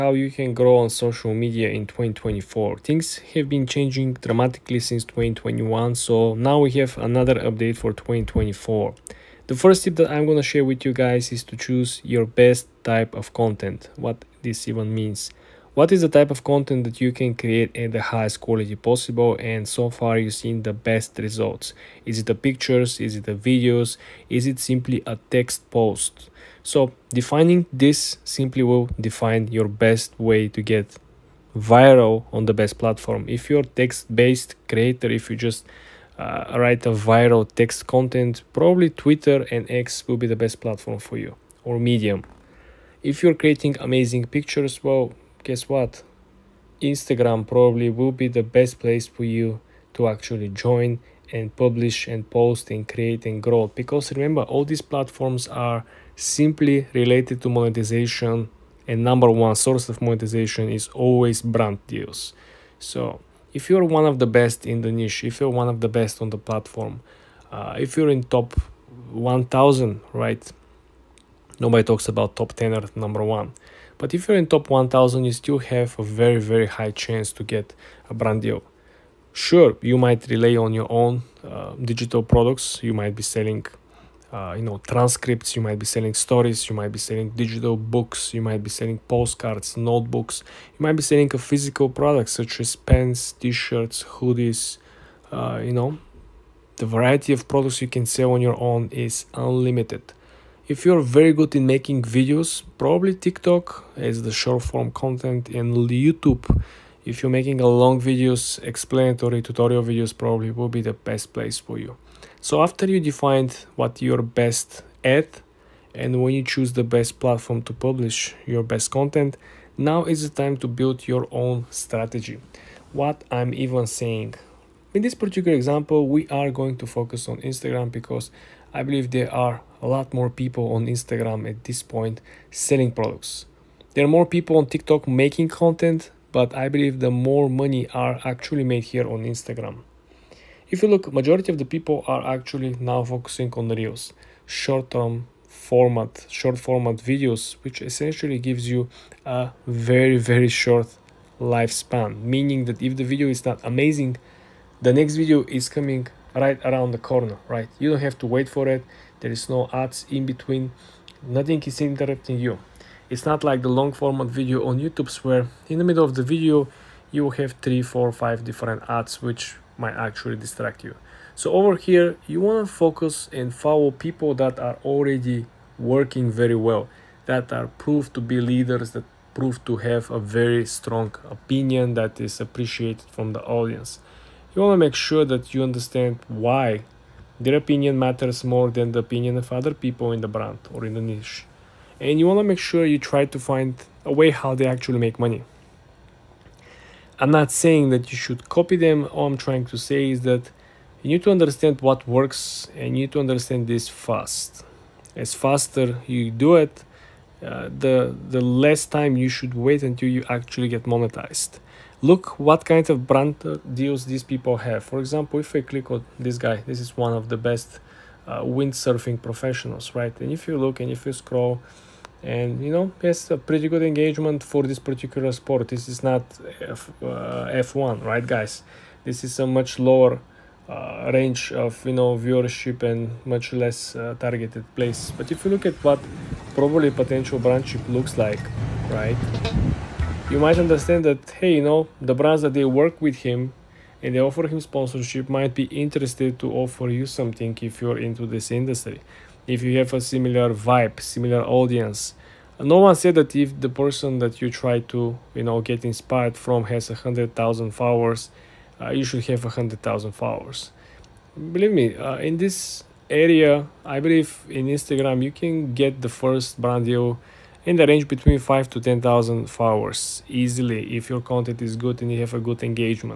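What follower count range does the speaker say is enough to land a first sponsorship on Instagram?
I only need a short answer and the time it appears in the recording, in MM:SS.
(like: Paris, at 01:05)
5 to 10,000, at 04:28.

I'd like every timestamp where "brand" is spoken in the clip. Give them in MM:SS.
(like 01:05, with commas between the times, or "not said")
01:01, 01:18, 03:10, 03:33, 03:57, 04:02, 04:26.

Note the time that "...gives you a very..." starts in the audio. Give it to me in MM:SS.
02:28.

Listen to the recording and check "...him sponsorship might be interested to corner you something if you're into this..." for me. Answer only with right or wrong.
wrong.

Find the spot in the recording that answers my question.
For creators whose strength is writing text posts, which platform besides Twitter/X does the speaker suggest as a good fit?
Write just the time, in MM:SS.
00:41.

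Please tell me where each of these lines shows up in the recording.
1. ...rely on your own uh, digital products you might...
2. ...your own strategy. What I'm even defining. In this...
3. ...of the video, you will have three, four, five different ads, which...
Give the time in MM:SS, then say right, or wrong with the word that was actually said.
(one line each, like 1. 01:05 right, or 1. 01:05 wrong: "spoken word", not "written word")
1. 01:20 right
2. 02:01 wrong: "saying", not "defining"
3. 02:46 right.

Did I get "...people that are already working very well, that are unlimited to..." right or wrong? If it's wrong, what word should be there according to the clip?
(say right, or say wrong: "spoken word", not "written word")
wrong: "proved", not "unlimited".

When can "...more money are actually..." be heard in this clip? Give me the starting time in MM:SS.
02:17.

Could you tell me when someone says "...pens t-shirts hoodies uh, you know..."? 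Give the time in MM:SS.
01:32.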